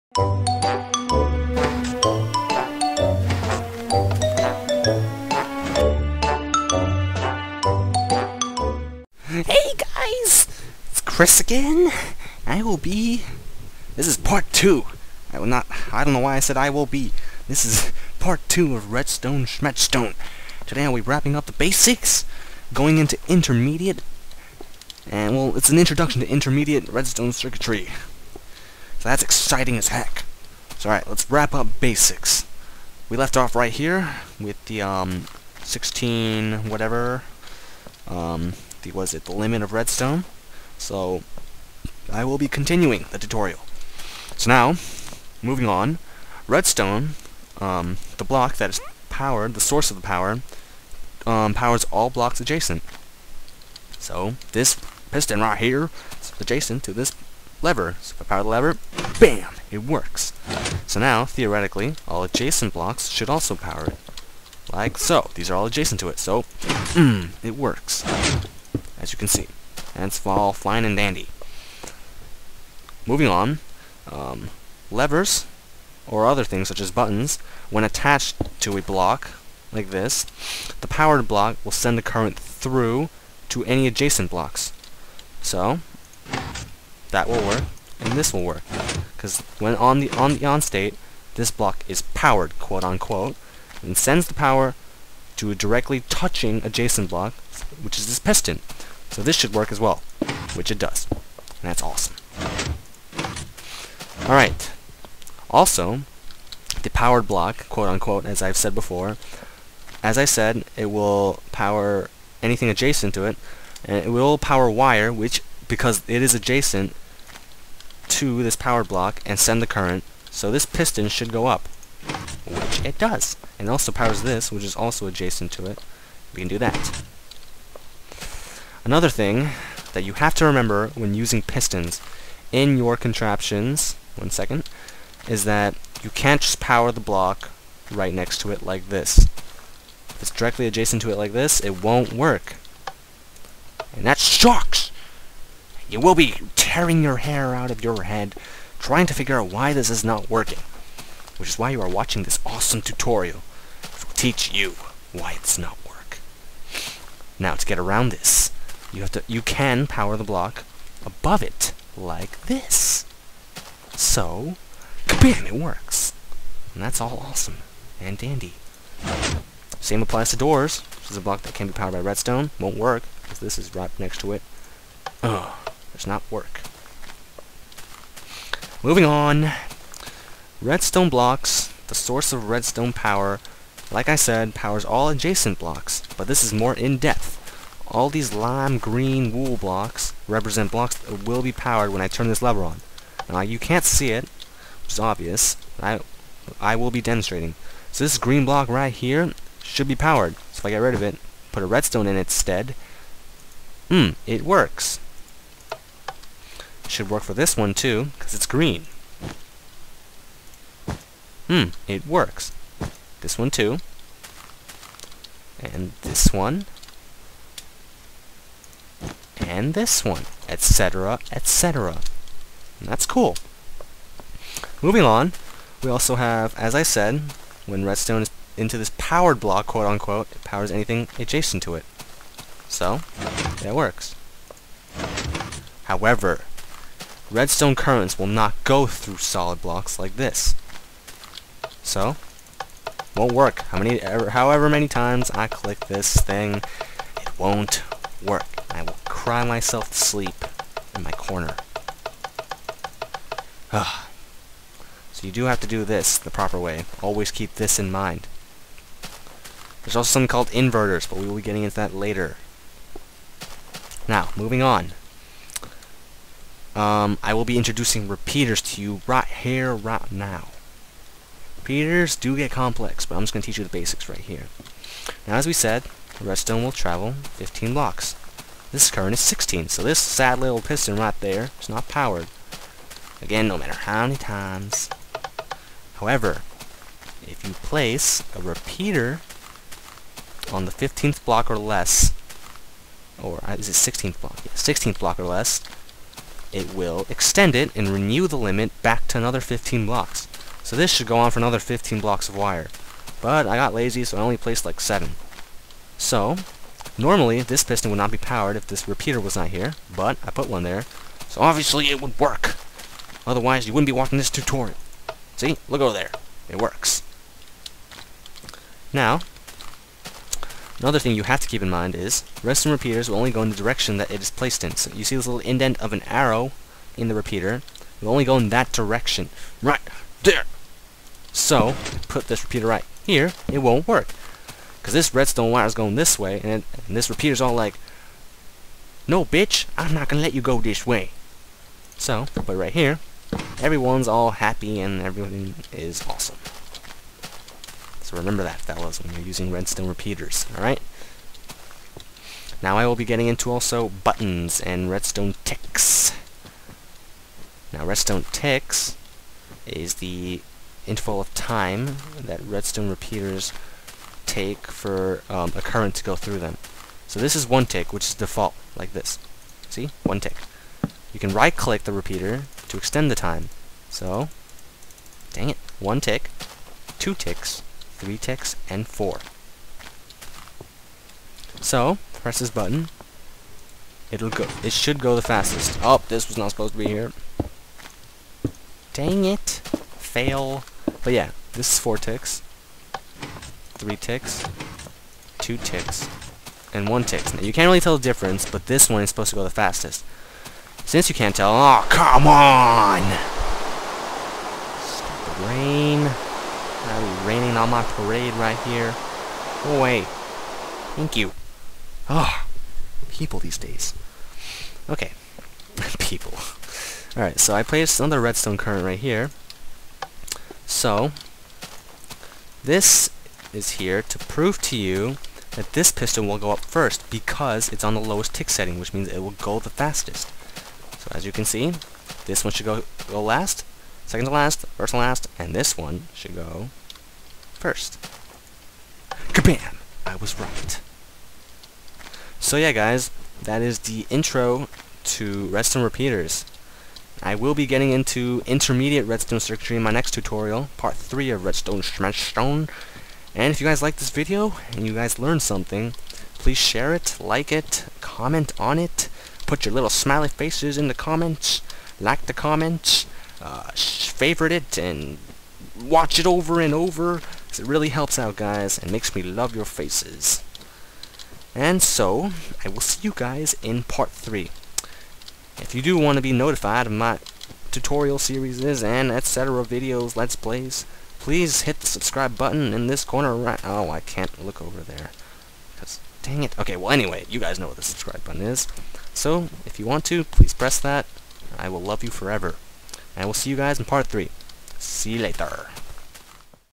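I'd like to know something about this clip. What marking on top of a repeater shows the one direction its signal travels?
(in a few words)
indent of an arrow.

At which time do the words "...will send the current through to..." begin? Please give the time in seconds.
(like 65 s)
81 s.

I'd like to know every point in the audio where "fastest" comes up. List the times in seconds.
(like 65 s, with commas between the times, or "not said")
385 s, 399 s, 429 s.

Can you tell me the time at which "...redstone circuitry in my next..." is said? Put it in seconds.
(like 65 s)
449 s.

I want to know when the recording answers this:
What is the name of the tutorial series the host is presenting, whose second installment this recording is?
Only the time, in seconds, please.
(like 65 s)
18 s.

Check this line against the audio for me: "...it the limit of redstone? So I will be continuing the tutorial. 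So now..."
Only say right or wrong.
right.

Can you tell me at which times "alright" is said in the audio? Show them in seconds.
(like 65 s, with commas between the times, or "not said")
30 s, 104 s, 350 s, 417 s.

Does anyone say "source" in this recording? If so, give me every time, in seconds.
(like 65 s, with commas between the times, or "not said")
49 s, 181 s.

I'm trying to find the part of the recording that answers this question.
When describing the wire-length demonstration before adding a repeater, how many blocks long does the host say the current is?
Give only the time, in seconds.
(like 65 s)
278 s.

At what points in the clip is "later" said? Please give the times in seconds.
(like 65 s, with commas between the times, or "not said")
261 s, 495 s.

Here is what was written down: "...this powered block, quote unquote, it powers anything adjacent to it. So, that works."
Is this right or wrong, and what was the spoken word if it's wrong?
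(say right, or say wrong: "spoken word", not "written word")
right.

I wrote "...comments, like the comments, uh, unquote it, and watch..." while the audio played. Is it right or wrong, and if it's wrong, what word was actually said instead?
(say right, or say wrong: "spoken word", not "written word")
wrong: "favorite", not "unquote".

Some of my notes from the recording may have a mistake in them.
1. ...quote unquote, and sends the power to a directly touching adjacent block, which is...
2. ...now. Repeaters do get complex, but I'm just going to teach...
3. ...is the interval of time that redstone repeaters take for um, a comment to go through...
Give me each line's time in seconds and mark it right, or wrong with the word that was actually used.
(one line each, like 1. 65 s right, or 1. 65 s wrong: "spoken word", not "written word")
1. 92 s right
2. 270 s right
3. 359 s wrong: "current", not "comment".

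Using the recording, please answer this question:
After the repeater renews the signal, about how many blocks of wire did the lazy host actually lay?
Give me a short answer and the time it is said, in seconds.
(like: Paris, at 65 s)
7, at 304 s.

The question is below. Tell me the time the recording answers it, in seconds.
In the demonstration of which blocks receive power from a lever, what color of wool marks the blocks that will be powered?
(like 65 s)
188 s.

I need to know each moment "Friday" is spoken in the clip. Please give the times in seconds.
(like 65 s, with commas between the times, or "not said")
not said.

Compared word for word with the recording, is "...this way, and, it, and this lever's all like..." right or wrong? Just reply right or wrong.
wrong.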